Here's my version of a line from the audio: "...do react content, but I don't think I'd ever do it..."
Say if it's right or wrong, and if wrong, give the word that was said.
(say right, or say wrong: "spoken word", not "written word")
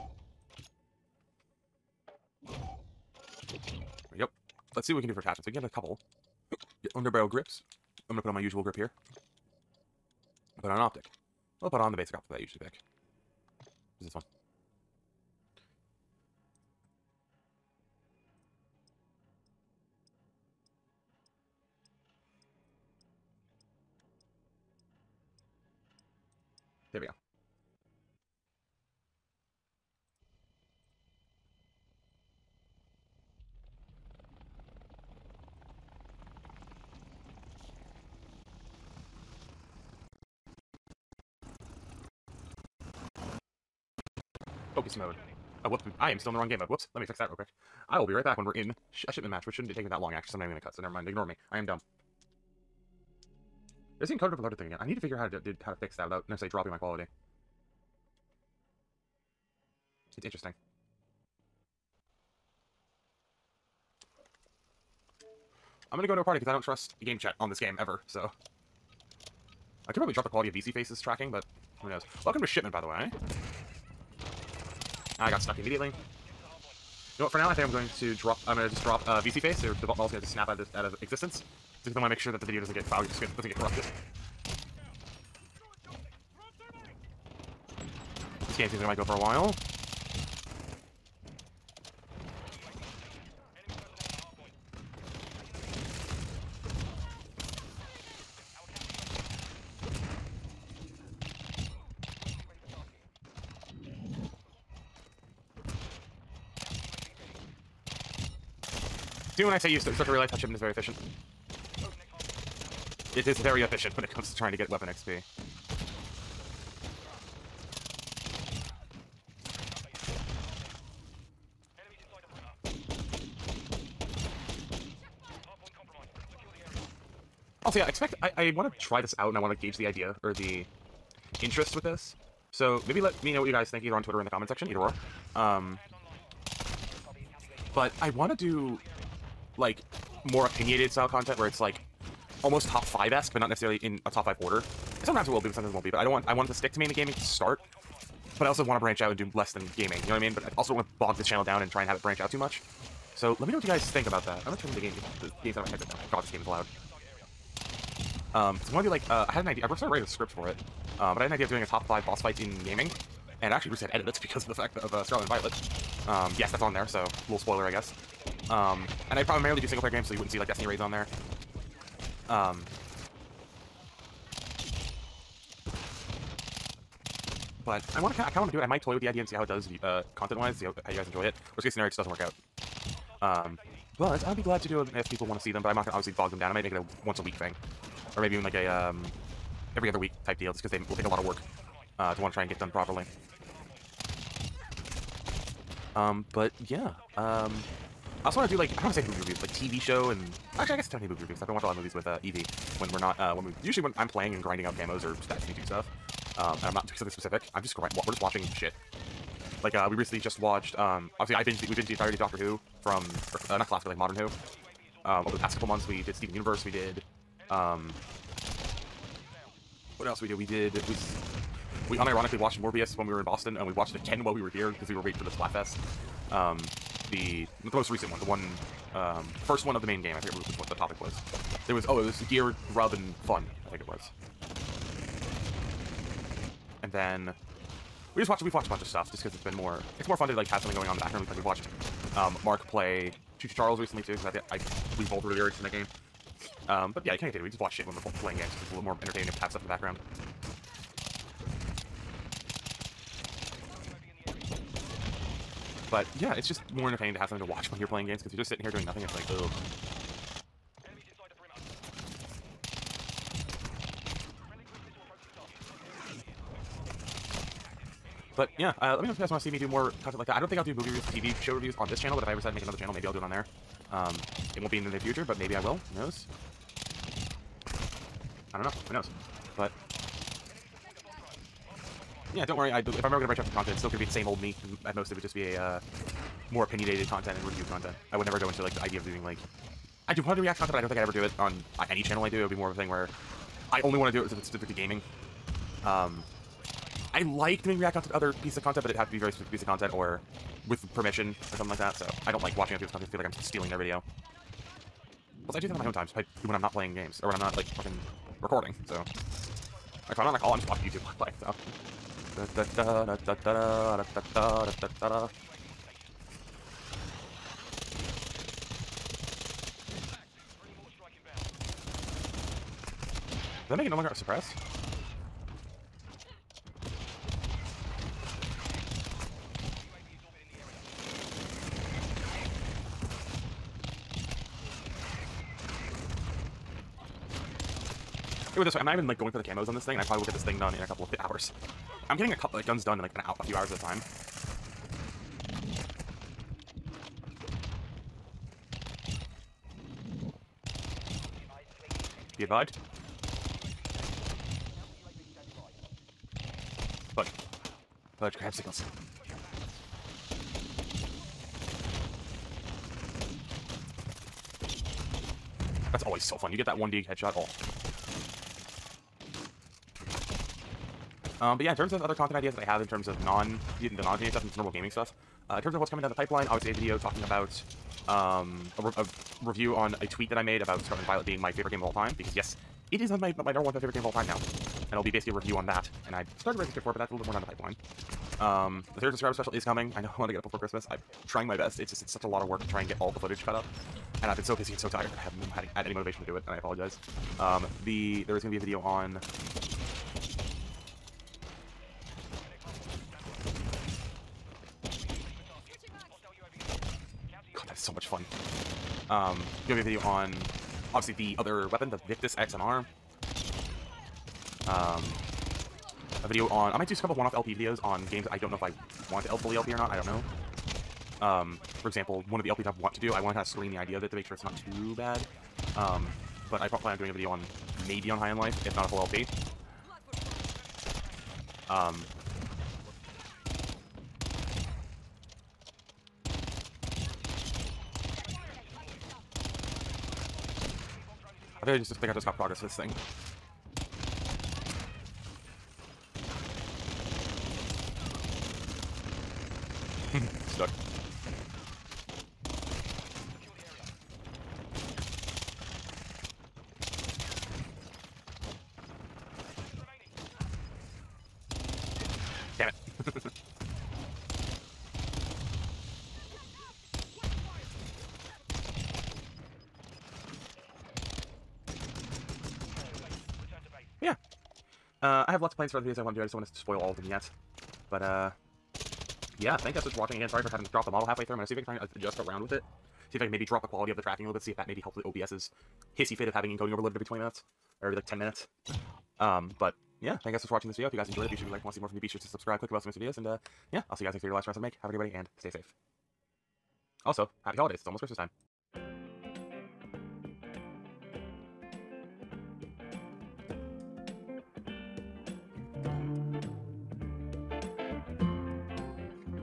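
right.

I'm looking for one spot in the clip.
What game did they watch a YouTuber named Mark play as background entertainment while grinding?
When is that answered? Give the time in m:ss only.
4:03.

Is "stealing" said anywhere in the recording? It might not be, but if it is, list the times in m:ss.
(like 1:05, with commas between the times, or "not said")
5:03.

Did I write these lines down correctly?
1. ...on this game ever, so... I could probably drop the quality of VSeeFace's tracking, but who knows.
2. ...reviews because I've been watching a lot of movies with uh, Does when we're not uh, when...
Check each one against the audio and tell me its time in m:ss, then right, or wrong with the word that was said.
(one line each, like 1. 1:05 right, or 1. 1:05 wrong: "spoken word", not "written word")
1. 1:07 right
2. 3:21 wrong: "Evie", not "Does".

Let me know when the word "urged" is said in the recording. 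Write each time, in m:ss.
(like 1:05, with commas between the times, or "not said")
4:05.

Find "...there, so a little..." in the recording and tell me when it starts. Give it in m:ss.
2:46.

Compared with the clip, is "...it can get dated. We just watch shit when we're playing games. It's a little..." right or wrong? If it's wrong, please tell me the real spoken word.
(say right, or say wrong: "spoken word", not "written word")
right.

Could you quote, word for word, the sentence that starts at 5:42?
I'm getting a couple like guns done in like an out a few hours at a time.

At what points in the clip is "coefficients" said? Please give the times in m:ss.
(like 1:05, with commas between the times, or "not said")
not said.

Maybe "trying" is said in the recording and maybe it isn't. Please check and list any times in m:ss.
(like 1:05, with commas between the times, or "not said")
1:54, 6:31.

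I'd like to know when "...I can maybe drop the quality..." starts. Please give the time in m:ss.
8:03.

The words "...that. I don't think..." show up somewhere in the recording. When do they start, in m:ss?
4:30.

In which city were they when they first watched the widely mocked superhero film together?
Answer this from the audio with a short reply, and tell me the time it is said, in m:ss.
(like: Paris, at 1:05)
Boston, at 3:43.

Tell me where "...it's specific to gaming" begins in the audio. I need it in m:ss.
4:54.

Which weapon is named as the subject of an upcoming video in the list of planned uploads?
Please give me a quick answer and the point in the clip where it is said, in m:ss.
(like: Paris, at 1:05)
Victus XMR, at 6:52.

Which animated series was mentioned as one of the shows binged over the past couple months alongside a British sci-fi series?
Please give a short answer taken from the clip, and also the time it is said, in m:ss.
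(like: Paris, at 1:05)
Steven Universe, at 3:36.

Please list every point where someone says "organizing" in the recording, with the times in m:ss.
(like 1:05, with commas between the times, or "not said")
not said.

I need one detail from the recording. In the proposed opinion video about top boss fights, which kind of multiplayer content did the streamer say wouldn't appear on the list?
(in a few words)
Destiny raids.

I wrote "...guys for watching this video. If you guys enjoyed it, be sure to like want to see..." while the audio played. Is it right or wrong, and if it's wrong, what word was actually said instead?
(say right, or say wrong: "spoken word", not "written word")
right.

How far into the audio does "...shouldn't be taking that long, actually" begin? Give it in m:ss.
0:49.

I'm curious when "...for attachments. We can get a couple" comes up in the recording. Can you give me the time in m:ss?
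0:05.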